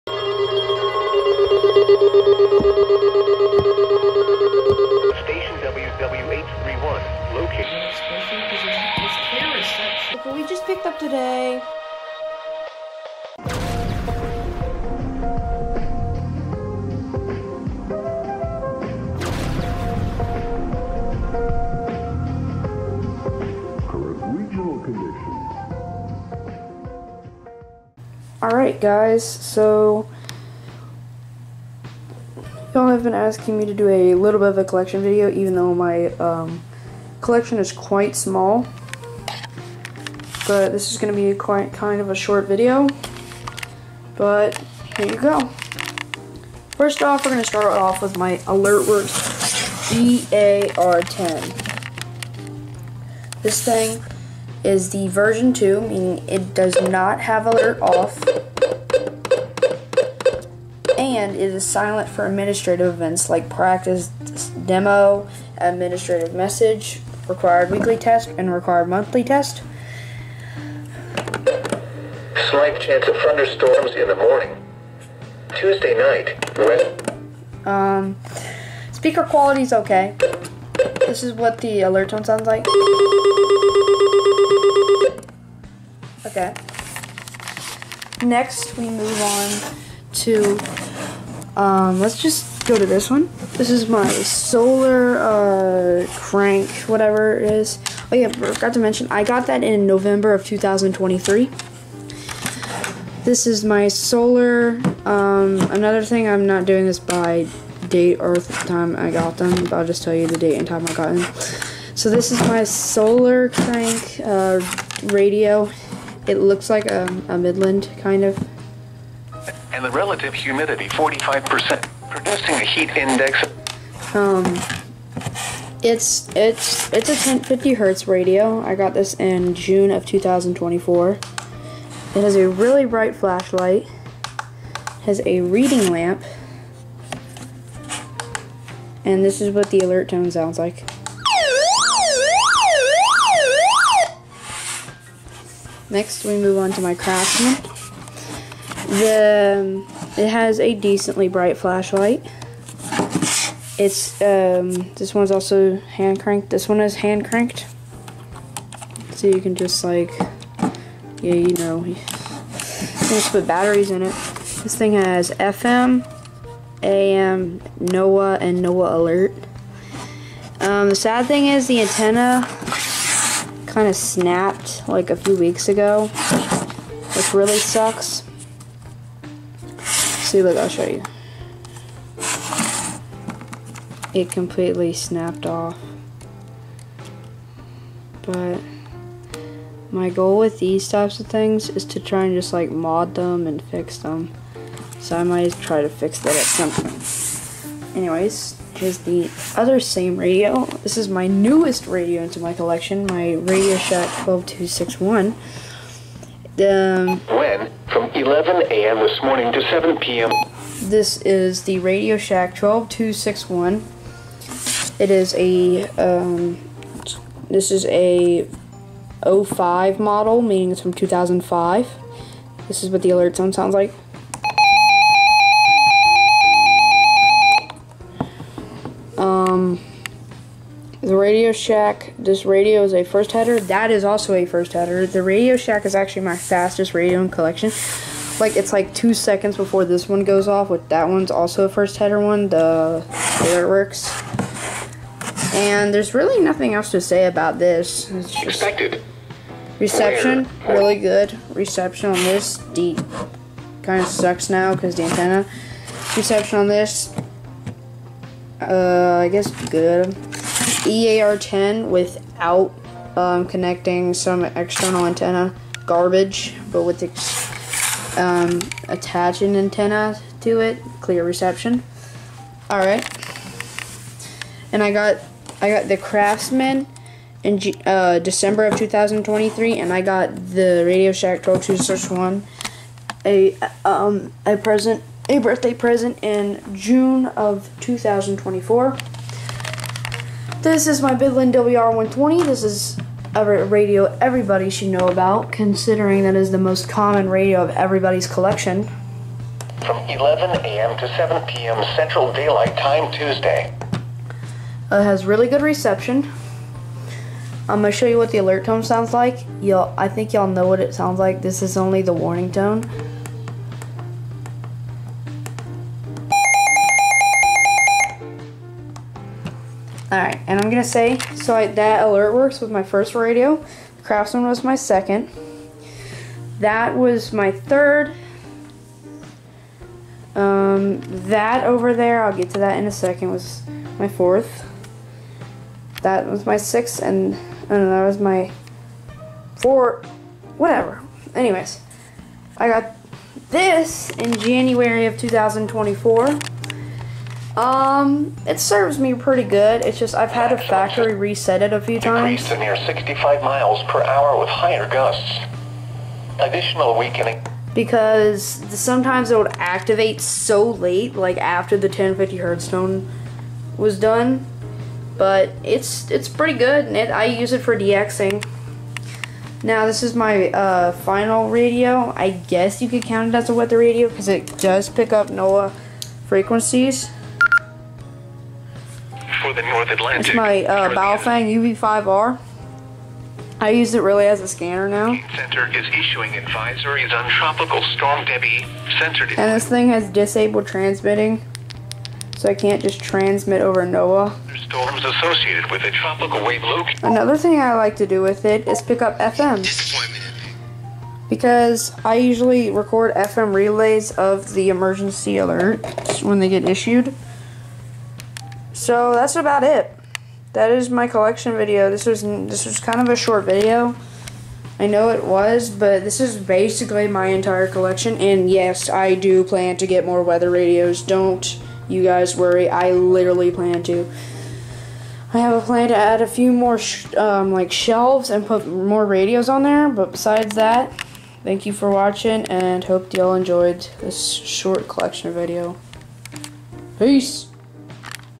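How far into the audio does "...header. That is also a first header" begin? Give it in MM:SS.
03:53.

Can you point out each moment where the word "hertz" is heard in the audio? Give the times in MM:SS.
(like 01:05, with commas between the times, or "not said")
02:07, 06:02.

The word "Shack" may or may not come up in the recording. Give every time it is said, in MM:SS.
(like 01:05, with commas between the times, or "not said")
03:23, 03:32, 03:51, 03:55, 04:41.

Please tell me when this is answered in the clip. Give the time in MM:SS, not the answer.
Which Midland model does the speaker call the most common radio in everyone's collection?
04:51.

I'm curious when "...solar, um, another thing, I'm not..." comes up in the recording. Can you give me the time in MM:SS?
01:43.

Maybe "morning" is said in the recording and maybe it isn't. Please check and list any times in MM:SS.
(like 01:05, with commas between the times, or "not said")
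01:14, 03:29.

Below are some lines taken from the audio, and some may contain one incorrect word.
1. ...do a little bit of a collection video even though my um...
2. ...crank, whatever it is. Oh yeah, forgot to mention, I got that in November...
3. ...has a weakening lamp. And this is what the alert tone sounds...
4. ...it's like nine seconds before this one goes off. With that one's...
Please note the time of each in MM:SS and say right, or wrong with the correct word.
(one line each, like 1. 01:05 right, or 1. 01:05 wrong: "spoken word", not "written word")
1. 00:33 right
2. 01:36 right
3. 02:15 wrong: "reading", not "weakening"
4. 03:58 wrong: "two", not "nine".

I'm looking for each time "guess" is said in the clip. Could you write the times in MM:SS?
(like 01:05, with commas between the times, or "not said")
04:19, 06:12.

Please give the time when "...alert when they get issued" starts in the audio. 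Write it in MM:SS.
06:45.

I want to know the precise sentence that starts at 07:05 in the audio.
I have a plan to add a few more um, like shelves and put more radios on there.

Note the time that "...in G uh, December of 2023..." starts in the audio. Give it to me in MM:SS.
04:37.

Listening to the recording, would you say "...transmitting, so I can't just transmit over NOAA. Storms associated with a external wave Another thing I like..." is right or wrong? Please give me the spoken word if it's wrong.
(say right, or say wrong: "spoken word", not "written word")
wrong: "tropical", not "external".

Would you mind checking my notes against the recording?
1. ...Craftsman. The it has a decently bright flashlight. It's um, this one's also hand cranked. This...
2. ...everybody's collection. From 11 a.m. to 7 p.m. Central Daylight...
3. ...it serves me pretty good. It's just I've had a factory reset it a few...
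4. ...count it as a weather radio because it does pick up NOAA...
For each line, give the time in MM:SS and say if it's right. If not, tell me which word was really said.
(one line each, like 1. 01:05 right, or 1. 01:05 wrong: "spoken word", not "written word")
1. 02:26 right
2. 04:57 right
3. 05:48 right
4. 06:13 right.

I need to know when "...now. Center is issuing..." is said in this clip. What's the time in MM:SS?
06:24.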